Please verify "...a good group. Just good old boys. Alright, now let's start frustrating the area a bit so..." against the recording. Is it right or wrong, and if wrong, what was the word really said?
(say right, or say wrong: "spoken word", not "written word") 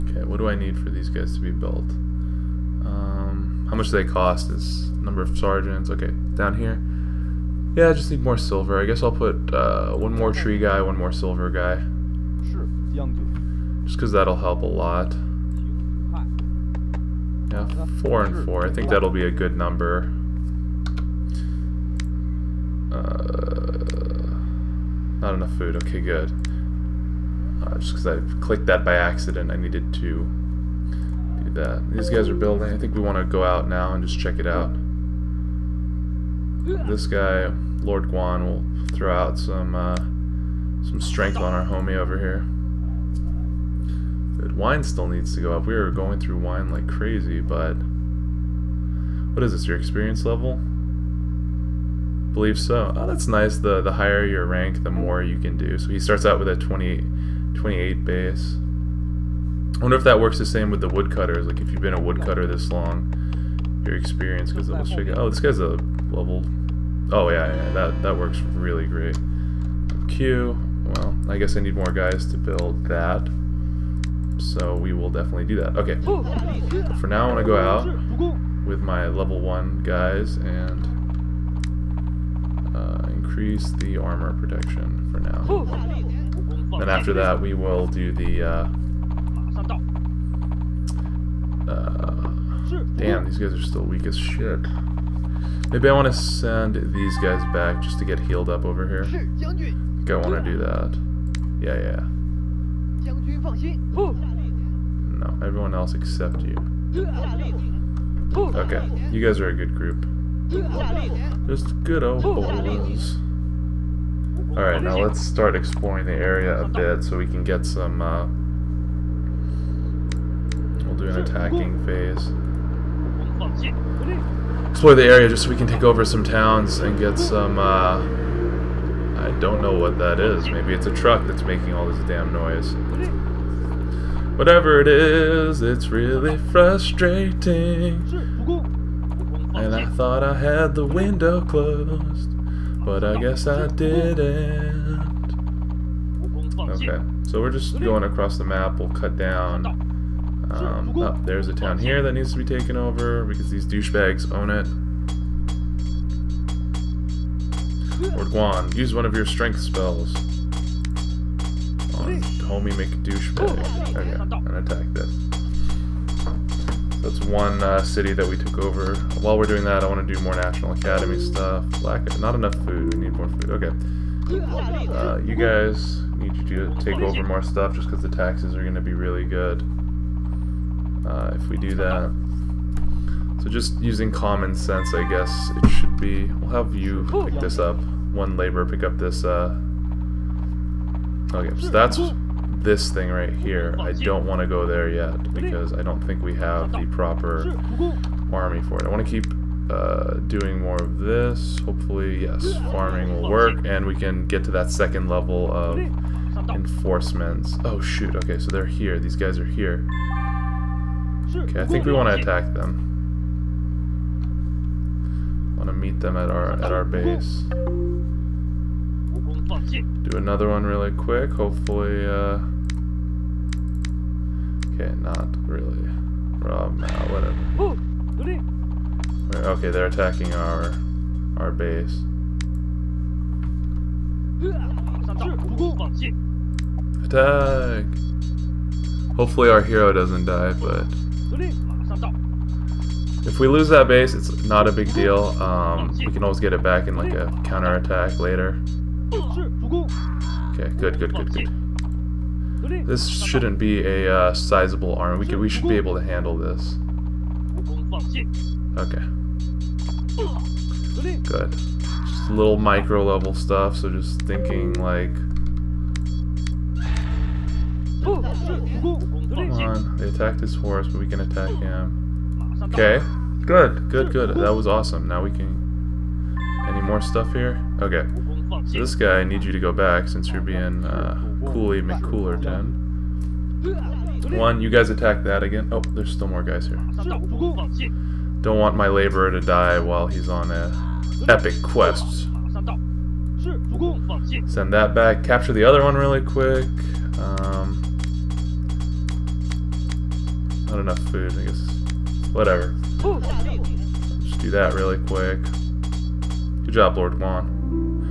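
wrong: "exploring", not "frustrating".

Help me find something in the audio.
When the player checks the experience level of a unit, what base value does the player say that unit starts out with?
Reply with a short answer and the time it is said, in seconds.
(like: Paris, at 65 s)
28, at 57 s.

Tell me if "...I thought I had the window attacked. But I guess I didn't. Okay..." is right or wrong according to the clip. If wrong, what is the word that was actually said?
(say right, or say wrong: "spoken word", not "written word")
wrong: "closed", not "attacked".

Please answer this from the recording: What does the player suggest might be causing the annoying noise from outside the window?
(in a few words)
A truck.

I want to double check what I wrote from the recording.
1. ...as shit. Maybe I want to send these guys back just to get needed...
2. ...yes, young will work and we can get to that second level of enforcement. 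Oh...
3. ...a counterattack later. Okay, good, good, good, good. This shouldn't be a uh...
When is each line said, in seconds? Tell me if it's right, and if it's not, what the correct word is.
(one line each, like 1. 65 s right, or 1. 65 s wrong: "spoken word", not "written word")
1. 94 s wrong: "healed", not "needed"
2. 202 s wrong: "farming", not "young"
3. 247 s right.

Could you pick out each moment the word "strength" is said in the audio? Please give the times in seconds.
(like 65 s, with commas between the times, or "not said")
41 s, 159 s.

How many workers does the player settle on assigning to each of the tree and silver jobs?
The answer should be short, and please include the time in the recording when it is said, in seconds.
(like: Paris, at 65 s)
4, at 17 s.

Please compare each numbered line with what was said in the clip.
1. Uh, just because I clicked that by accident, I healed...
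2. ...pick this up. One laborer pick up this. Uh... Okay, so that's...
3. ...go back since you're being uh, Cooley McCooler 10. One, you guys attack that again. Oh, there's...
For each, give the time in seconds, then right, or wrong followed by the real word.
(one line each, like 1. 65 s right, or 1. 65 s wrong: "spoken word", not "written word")
1. 27 s wrong: "needed", not "healed"
2. 187 s right
3. 279 s right.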